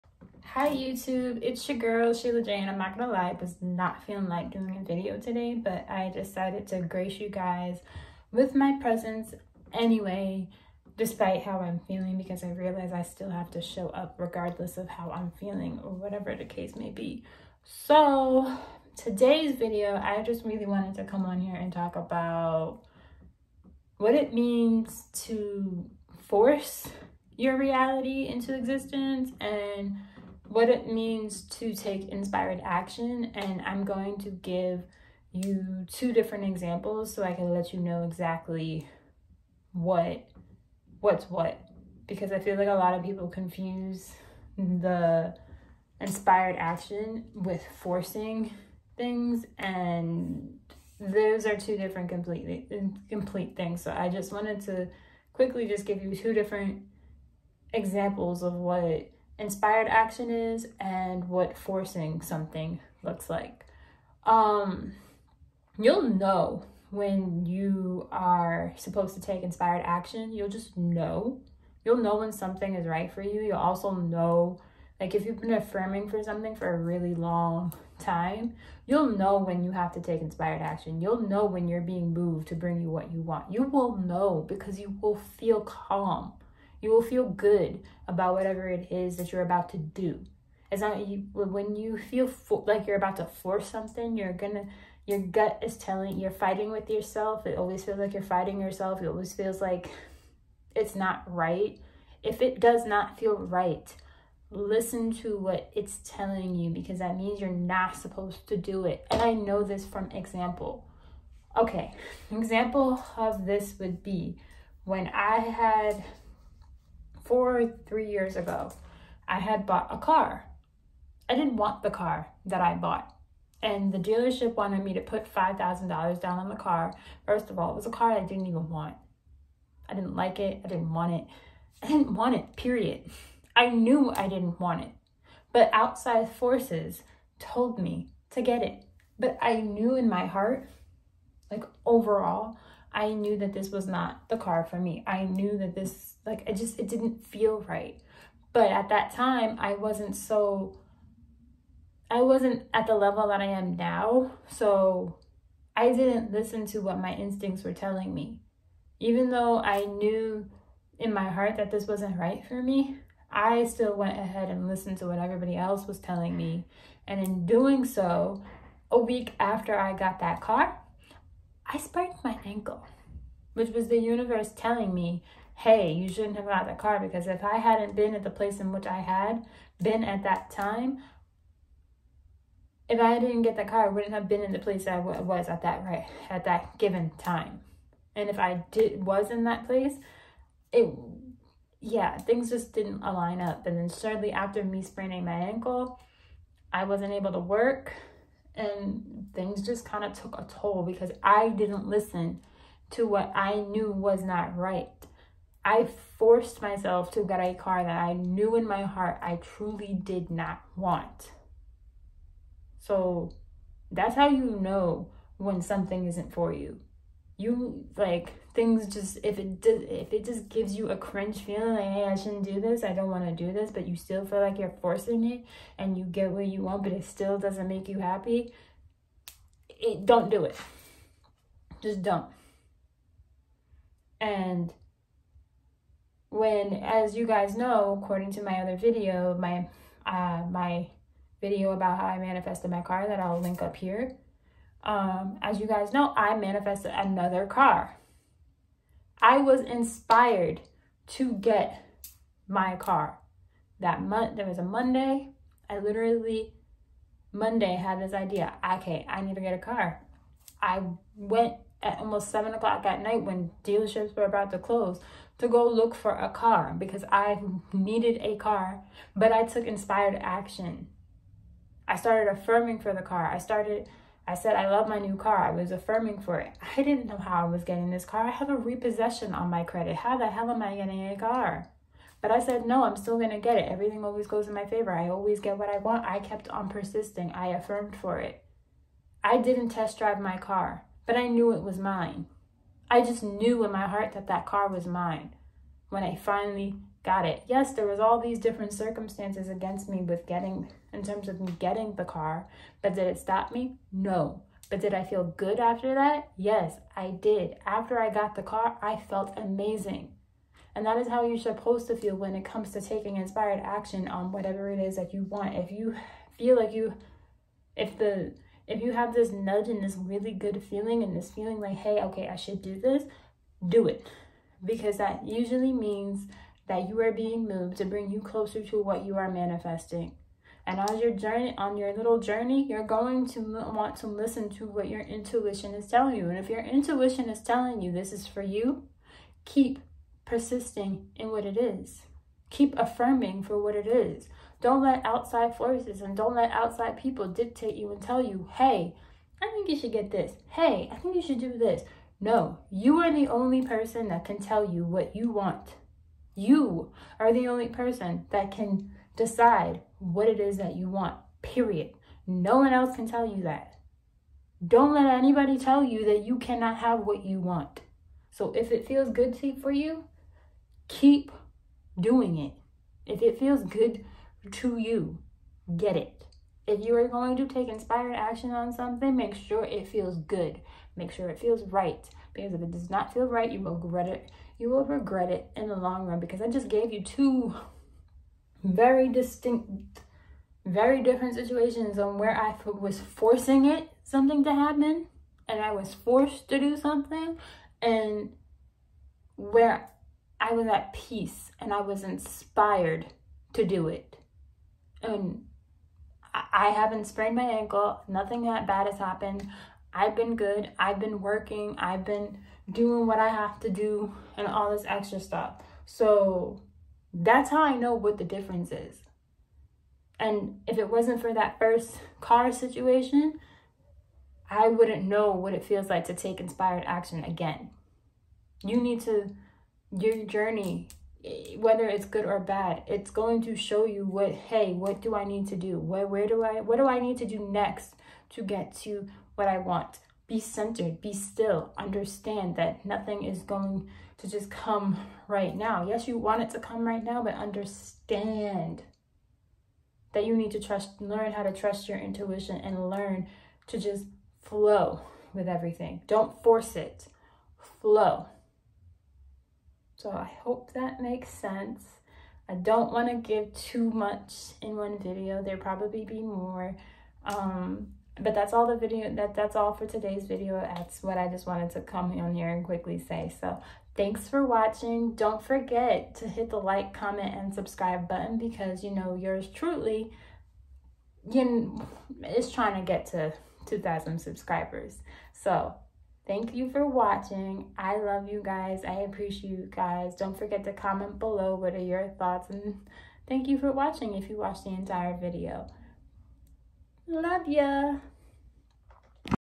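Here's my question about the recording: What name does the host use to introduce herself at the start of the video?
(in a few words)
Sheila J.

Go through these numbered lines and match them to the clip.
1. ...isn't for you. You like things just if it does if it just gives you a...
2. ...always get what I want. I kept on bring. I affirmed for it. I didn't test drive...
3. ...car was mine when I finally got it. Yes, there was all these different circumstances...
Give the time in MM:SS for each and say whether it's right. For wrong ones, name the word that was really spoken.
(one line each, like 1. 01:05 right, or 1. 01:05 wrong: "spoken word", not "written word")
1. 03:36 right
2. 04:45 wrong: "persisting", not "bring"
3. 04:54 right.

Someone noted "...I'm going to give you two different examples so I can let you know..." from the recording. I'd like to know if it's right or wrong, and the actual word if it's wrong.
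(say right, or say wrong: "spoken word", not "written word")
right.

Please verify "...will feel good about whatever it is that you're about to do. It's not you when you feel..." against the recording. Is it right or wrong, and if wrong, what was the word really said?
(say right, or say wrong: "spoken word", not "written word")
right.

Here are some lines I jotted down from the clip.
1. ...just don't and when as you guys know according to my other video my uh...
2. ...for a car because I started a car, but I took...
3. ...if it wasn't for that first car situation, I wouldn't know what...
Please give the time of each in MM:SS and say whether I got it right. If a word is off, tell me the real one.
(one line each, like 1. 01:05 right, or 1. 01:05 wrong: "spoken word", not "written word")
1. 03:51 right
2. 04:25 wrong: "needed", not "started"
3. 07:00 right.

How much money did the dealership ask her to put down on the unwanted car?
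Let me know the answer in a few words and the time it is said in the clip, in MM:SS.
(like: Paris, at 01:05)
$5,000, at 02:05.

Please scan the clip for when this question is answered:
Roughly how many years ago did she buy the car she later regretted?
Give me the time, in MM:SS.
01:57.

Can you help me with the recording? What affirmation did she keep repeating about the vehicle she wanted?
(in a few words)
I love my new car.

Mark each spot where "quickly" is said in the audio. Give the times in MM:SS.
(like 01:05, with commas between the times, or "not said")
00:55, 07:52.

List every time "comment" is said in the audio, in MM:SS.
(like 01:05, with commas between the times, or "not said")
07:56, 08:10.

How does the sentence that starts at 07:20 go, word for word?
Be centered, be still, understand that nothing is going to just come right now.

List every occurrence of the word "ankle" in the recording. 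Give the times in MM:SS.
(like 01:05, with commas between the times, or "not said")
02:52, 03:15, 06:47.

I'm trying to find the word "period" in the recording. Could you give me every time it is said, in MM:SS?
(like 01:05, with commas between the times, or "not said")
02:12, 06:01.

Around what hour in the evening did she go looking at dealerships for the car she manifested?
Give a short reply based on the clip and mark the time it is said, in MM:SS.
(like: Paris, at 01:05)
7 o'clock, at 04:22.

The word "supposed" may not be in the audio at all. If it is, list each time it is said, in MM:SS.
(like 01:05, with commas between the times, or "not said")
01:08, 01:47, 05:11.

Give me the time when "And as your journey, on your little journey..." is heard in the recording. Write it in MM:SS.
05:30.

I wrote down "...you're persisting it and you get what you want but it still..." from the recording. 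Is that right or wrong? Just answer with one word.
wrong.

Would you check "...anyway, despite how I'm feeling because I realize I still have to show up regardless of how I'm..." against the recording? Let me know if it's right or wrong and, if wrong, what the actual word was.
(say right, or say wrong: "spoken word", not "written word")
right.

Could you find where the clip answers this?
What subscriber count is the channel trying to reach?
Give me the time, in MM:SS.
08:03.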